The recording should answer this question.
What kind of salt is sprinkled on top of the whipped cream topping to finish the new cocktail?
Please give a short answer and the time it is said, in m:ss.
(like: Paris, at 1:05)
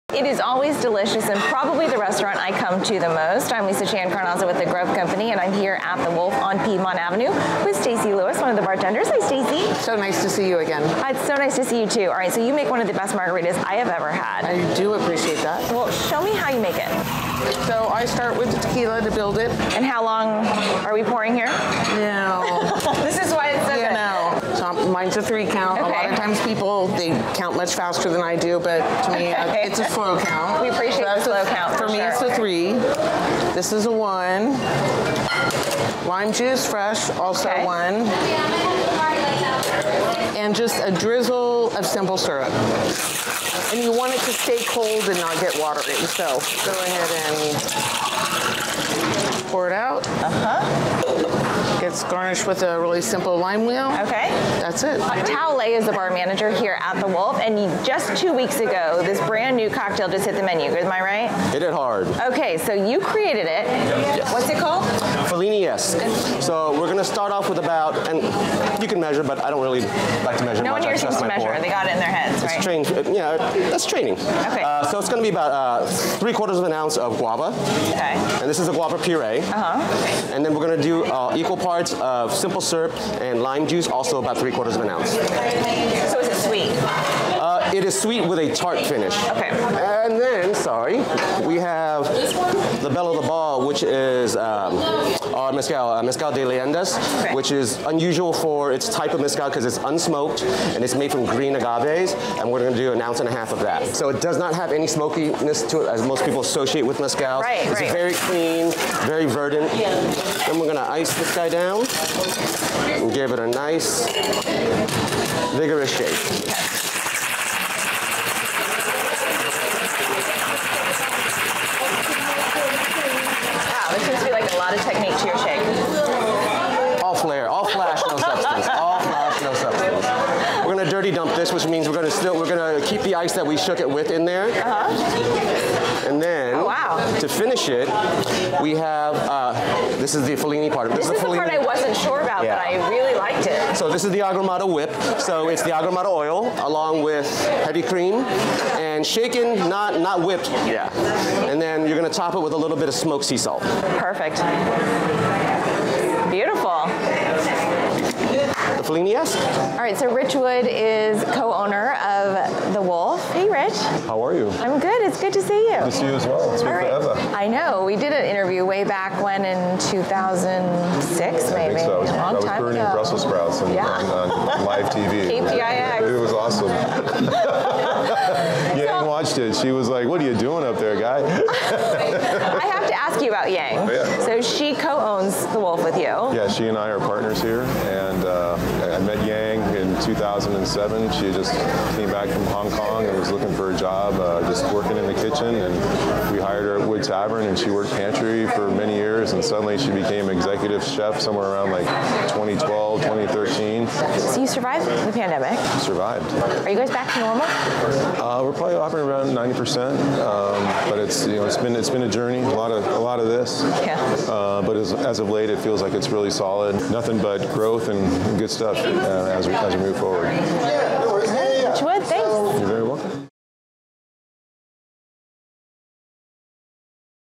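Smoked sea salt, at 2:32.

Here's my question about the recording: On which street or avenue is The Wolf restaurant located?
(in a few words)
Piedmont Avenue.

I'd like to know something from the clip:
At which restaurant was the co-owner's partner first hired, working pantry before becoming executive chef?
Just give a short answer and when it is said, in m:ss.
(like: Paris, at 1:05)
Wood Tavern, at 3:16.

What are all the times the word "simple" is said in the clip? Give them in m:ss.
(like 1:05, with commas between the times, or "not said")
0:41, 0:53, 1:22.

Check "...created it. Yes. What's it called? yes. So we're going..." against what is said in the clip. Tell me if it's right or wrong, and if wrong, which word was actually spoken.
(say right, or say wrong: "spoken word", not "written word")
right.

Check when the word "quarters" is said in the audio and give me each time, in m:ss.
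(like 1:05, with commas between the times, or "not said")
1:16, 1:24.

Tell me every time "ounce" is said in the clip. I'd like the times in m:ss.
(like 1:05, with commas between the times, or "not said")
1:16, 1:24, 1:43.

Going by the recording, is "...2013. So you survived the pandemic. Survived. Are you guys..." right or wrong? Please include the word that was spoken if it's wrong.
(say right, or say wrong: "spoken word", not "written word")
right.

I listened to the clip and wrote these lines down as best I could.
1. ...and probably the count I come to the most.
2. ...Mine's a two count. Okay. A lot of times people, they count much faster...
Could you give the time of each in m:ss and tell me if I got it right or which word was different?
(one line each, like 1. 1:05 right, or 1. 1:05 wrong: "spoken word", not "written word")
1. 0:01 wrong: "restaurant", not "count"
2. 0:24 wrong: "three", not "two".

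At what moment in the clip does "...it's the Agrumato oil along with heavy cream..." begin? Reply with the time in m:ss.
2:25.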